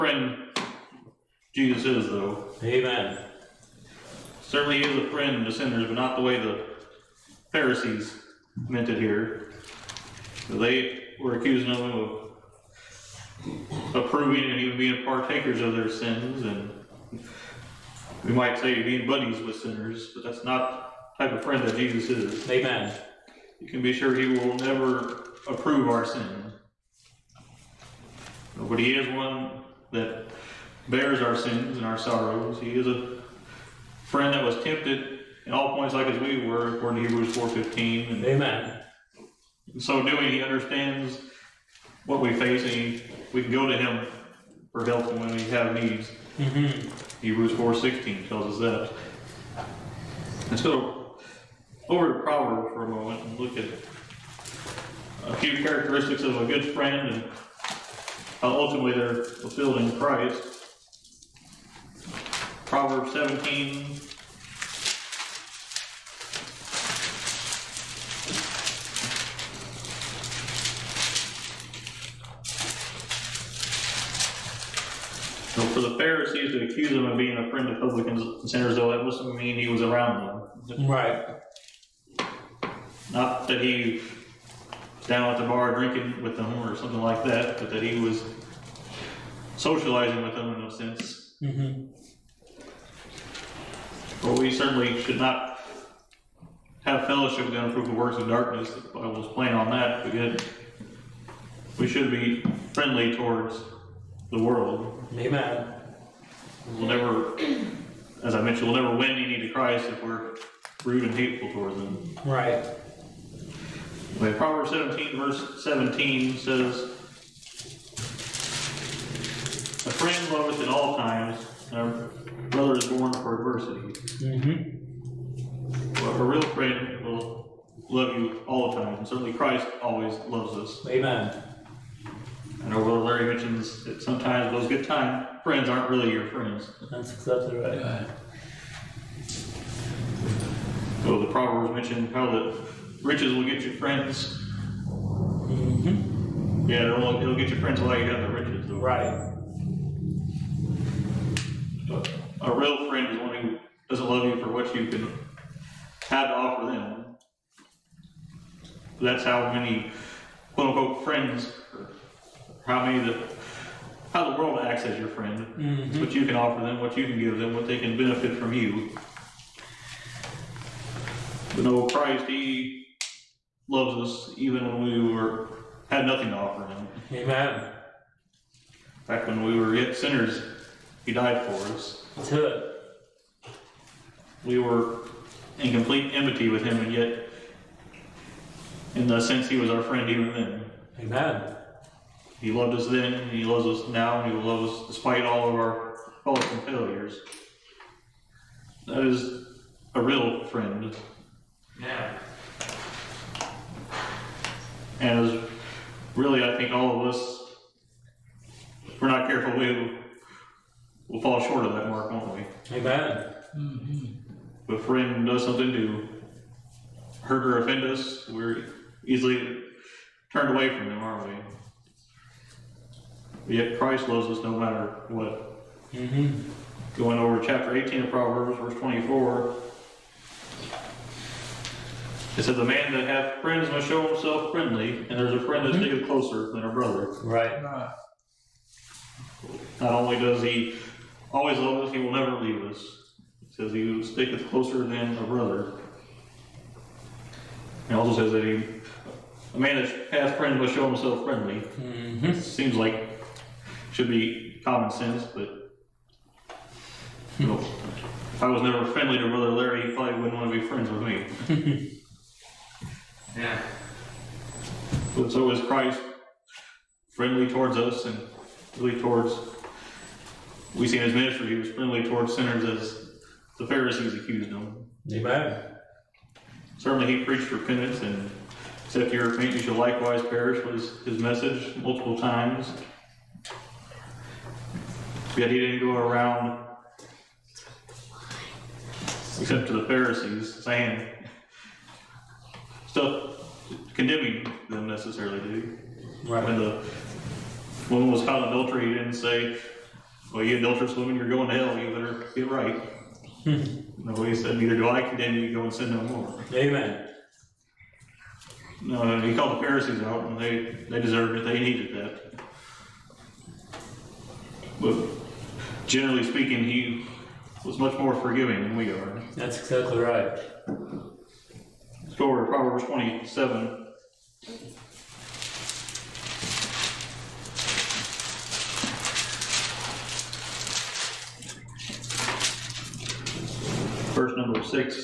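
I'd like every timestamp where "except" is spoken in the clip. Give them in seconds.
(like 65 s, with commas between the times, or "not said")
278 s, 289 s.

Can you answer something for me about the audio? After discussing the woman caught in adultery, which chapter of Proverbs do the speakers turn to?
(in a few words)
Proverbs 27.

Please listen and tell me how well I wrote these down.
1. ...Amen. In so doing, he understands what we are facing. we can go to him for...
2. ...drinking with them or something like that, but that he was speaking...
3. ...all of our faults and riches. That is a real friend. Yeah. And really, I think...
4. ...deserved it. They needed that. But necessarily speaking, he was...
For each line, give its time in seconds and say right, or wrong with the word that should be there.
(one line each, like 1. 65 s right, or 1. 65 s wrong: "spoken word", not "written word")
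1. 38 s right
2. 85 s wrong: "socializing", not "speaking"
3. 195 s wrong: "failures", not "riches"
4. 310 s wrong: "generally", not "necessarily".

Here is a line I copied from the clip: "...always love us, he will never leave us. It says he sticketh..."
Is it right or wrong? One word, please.
right.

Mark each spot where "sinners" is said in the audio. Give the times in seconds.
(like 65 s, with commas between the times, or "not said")
5 s, 19 s, 78 s, 179 s, 272 s.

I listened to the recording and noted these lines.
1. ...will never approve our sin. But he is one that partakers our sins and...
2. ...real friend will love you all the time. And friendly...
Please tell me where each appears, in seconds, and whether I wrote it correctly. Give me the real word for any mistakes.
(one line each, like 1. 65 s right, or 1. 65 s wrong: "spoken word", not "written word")
1. 24 s wrong: "bears", not "partakers"
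2. 126 s wrong: "certainly", not "friendly".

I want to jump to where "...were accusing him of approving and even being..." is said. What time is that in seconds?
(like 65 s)
11 s.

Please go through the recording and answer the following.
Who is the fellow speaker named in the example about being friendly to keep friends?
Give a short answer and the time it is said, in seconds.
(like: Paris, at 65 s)
Brother Larry, at 259 s.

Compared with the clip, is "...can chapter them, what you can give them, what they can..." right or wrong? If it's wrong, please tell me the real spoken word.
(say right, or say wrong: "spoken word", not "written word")
wrong: "offer", not "chapter".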